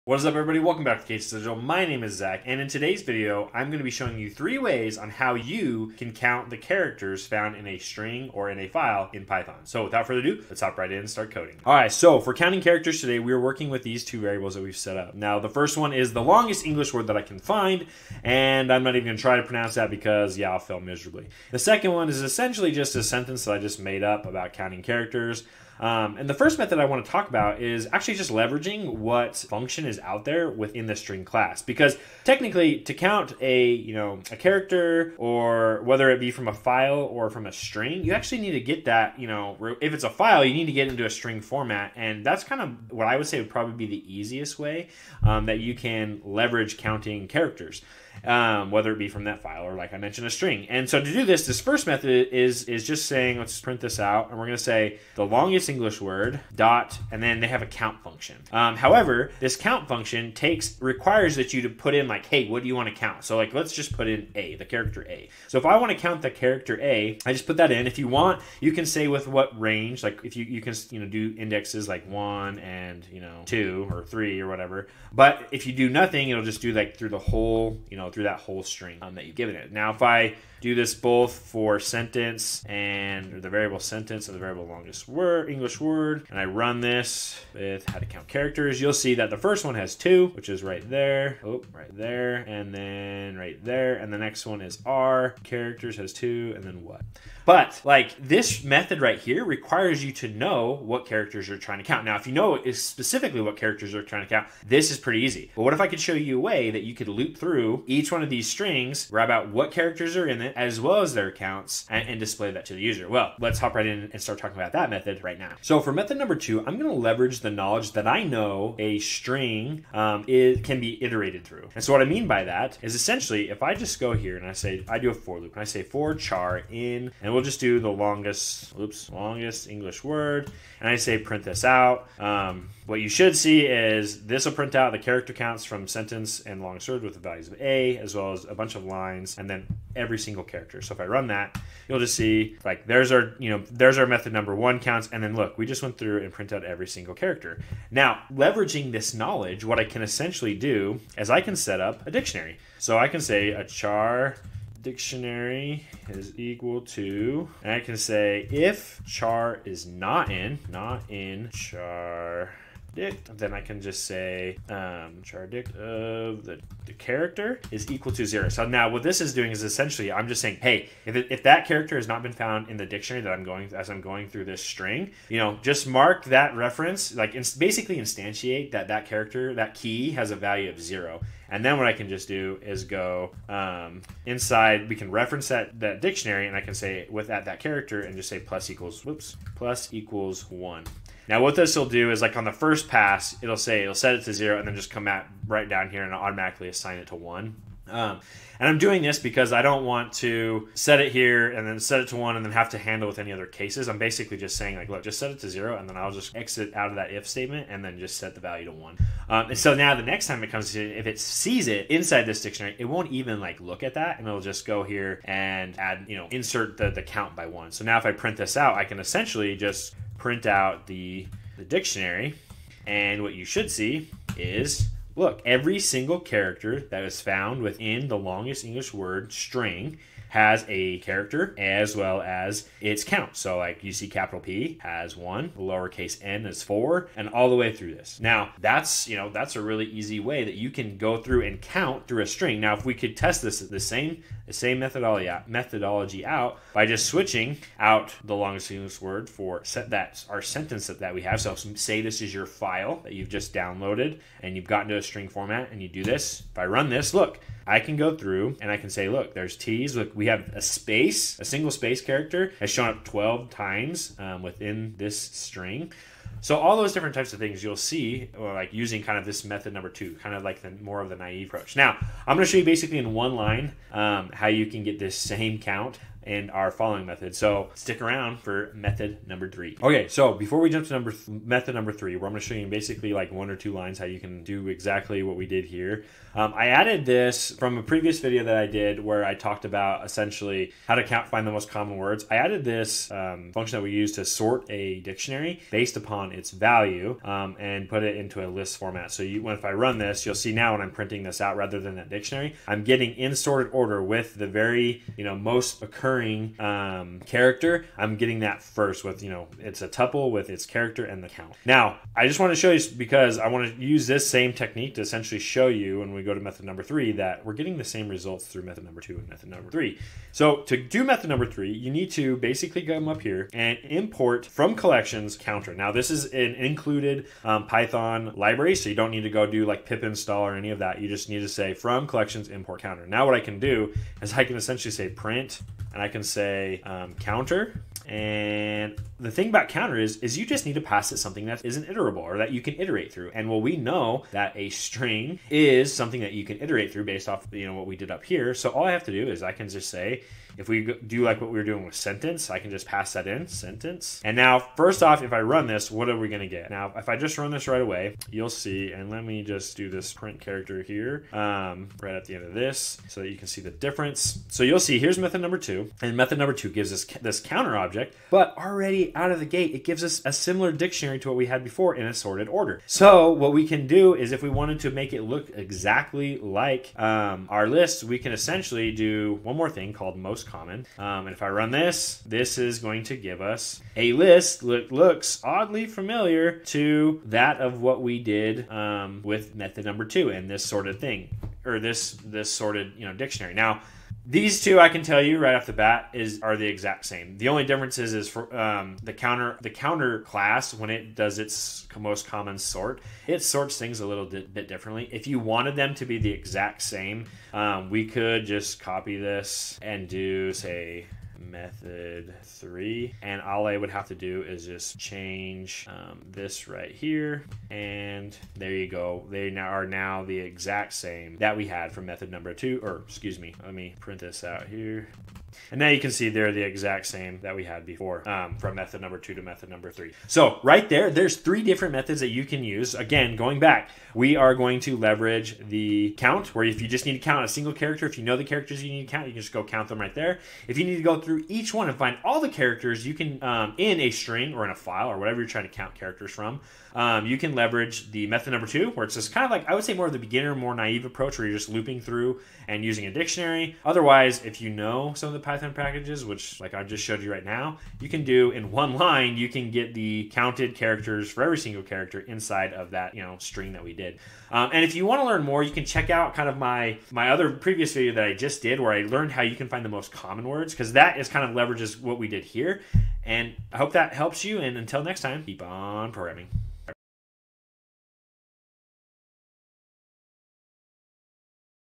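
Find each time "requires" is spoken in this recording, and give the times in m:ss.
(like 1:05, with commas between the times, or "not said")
1:00, 1:39.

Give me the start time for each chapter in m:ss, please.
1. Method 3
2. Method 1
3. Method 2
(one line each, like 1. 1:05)
1. 4:40
2. 0:12
3. 1:56.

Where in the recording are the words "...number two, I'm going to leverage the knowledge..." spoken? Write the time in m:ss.
1:56.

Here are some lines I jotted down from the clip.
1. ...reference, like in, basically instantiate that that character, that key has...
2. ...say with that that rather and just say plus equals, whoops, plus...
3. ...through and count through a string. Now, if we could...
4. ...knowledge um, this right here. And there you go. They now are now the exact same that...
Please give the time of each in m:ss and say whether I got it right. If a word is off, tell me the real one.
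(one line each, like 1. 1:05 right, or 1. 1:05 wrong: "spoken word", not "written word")
1. 2:56 right
2. 3:06 wrong: "character", not "rather"
3. 4:01 right
4. 6:54 wrong: "change", not "knowledge".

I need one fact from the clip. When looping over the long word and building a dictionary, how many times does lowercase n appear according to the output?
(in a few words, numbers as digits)
4.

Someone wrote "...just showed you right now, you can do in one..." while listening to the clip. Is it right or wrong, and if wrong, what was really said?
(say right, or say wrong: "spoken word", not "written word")
right.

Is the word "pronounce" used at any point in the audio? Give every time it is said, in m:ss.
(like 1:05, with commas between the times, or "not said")
0:19.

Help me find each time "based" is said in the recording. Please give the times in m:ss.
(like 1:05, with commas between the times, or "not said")
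4:55, 5:47.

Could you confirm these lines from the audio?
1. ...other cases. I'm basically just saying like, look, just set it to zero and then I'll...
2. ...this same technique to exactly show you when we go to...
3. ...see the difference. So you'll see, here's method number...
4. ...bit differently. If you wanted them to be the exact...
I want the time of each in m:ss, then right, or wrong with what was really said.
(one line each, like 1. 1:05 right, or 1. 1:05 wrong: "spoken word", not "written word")
1. 3:23 right
2. 5:14 wrong: "essentially", not "exactly"
3. 6:03 right
4. 6:44 right.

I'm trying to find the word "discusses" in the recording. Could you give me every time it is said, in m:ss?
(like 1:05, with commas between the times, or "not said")
not said.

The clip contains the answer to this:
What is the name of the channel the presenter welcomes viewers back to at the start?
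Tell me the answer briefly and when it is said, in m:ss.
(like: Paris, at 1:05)
Case Digital, at 0:01.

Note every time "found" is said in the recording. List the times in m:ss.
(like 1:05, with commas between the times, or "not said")
0:07, 2:52, 3:47.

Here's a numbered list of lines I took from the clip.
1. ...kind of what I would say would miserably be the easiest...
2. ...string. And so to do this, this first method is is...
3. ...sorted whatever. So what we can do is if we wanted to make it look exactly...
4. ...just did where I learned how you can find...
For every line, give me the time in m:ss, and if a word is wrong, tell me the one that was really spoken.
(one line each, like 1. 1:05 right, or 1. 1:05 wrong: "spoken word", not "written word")
1. 0:42 wrong: "probably", not "miserably"
2. 0:50 right
3. 6:12 wrong: "order", not "whatever"
4. 7:48 right.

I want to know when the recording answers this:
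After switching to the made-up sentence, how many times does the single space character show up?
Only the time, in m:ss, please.
4:23.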